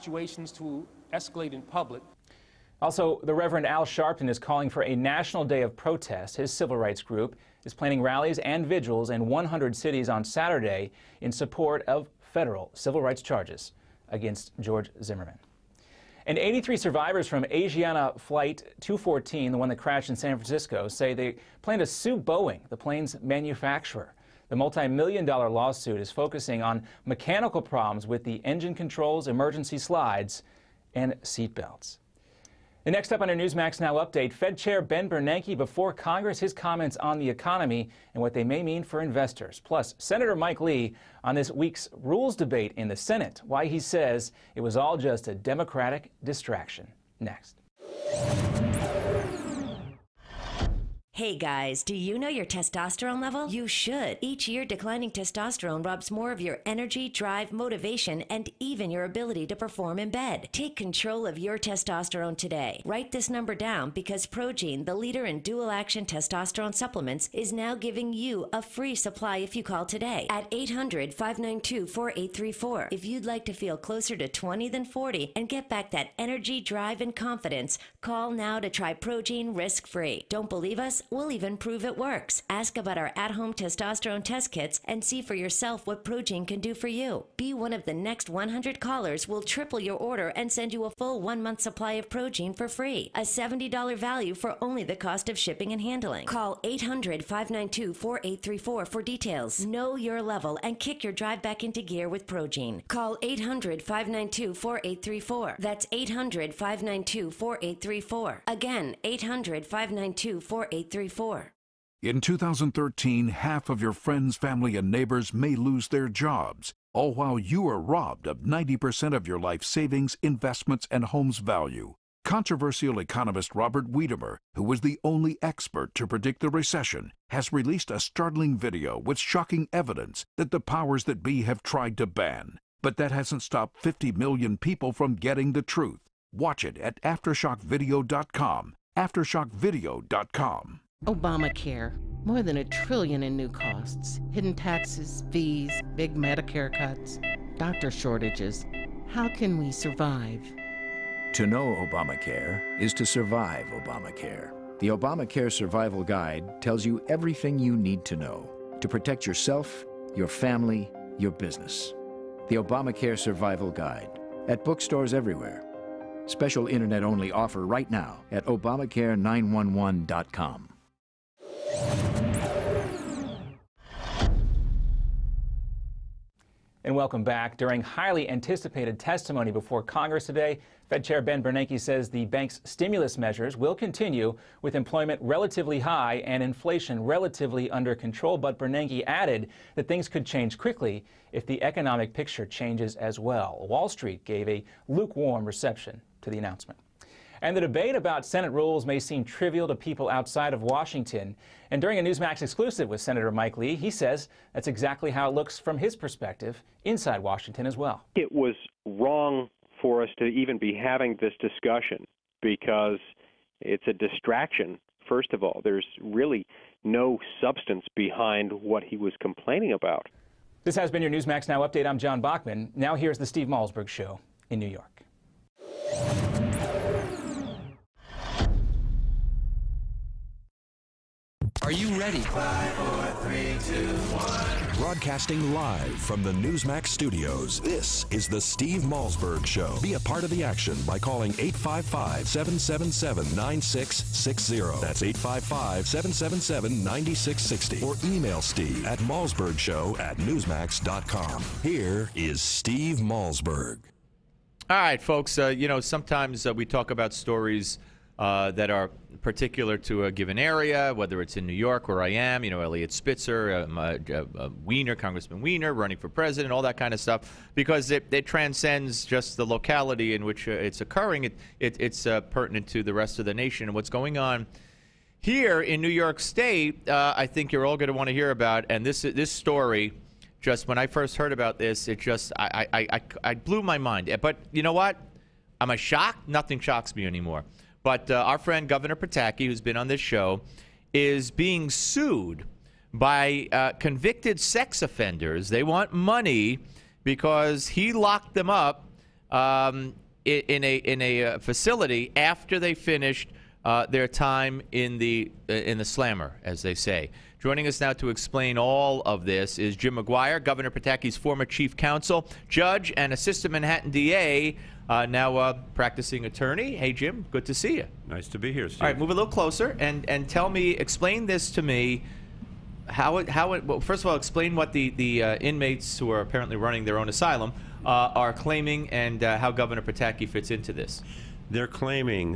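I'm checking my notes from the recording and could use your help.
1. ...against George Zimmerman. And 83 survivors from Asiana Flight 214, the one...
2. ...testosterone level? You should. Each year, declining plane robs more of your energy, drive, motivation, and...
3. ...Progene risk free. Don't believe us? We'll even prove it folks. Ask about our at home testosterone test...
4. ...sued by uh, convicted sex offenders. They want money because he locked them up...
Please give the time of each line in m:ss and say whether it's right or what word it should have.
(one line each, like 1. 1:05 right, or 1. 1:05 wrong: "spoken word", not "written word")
1. 0:14 right
2. 0:52 wrong: "testosterone", not "plane"
3. 1:18 wrong: "works", not "folks"
4. 4:51 right.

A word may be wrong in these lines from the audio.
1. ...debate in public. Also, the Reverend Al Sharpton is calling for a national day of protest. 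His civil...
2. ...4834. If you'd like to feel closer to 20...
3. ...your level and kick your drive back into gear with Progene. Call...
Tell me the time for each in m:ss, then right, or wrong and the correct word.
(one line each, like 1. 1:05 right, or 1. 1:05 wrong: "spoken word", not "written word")
1. 0:01 wrong: "escalate", not "debate"
2. 1:11 right
3. 1:39 right.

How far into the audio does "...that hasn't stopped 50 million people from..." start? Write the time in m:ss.
2:12.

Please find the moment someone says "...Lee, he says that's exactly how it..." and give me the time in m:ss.
3:23.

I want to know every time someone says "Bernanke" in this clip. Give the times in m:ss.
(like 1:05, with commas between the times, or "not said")
0:35, 3:01, 3:08.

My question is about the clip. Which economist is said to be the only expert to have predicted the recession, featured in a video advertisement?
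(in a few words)
Robert Wiedemer.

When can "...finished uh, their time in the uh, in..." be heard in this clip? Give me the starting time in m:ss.
5:02.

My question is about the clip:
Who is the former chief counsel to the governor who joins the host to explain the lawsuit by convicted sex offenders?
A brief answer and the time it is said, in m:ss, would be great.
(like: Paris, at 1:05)
Jim McGuire, at 5:09.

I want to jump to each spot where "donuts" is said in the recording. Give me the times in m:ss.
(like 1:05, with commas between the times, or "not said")
not said.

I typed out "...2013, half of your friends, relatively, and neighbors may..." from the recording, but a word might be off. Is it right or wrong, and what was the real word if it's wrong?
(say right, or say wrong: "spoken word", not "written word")
wrong: "family", not "relatively".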